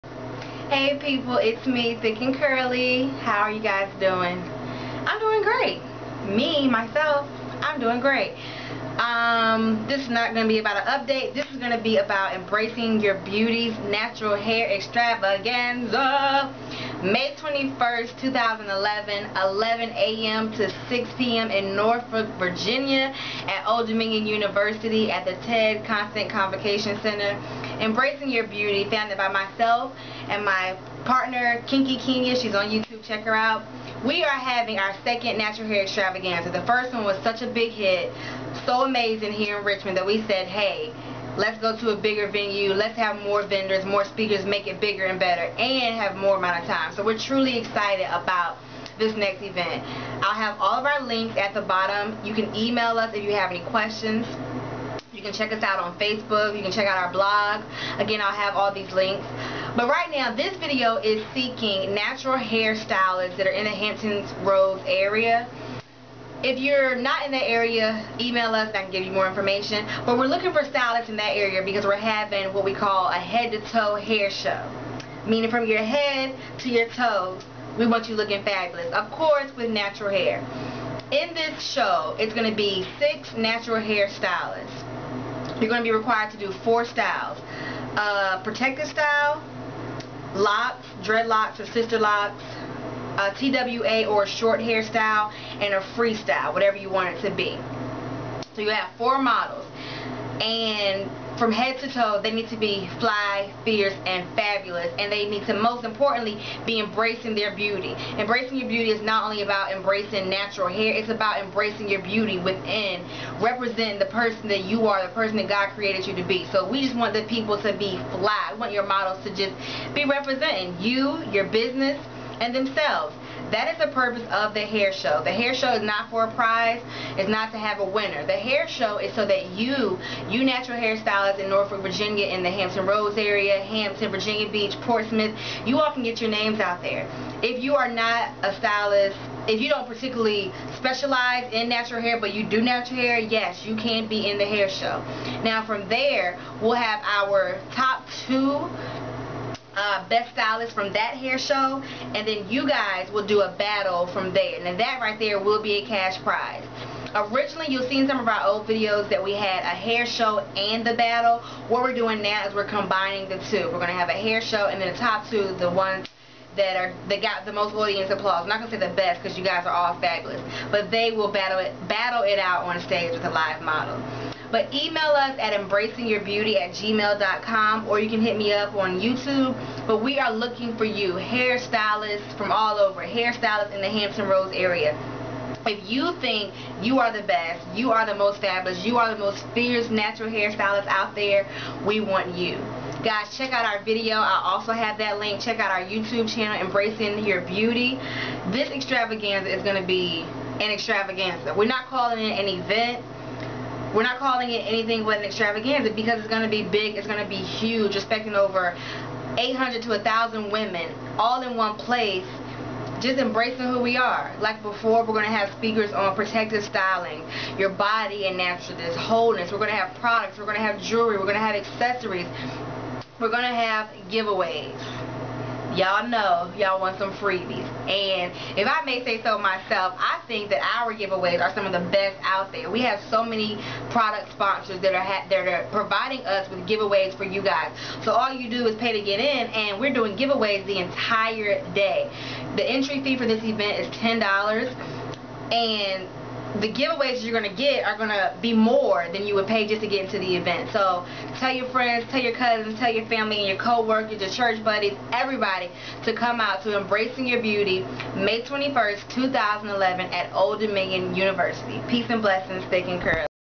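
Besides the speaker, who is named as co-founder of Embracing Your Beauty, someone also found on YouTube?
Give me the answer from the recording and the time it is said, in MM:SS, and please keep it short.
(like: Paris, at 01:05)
Kinky Kenya, at 00:31.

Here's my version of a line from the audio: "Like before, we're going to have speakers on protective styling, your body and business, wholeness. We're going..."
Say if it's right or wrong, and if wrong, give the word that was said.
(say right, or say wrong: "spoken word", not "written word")
wrong: "naturalness", not "business".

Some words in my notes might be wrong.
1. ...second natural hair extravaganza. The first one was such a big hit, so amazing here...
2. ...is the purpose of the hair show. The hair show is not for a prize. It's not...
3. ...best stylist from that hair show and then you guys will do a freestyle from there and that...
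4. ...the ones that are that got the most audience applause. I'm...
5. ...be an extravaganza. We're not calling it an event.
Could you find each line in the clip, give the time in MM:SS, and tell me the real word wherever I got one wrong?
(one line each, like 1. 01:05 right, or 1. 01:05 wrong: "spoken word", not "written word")
1. 00:35 right
2. 02:03 right
3. 02:30 wrong: "battle", not "freestyle"
4. 02:45 right
5. 03:19 right.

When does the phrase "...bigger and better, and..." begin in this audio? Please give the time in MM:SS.
00:44.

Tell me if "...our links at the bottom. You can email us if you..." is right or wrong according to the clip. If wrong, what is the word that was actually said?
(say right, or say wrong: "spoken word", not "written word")
right.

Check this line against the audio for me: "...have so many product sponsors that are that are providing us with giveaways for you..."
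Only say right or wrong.
right.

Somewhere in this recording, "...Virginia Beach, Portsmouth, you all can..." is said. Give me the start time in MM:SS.
02:14.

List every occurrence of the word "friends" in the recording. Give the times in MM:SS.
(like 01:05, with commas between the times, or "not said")
04:11.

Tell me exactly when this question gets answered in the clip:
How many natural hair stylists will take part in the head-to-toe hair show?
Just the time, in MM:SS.
01:22.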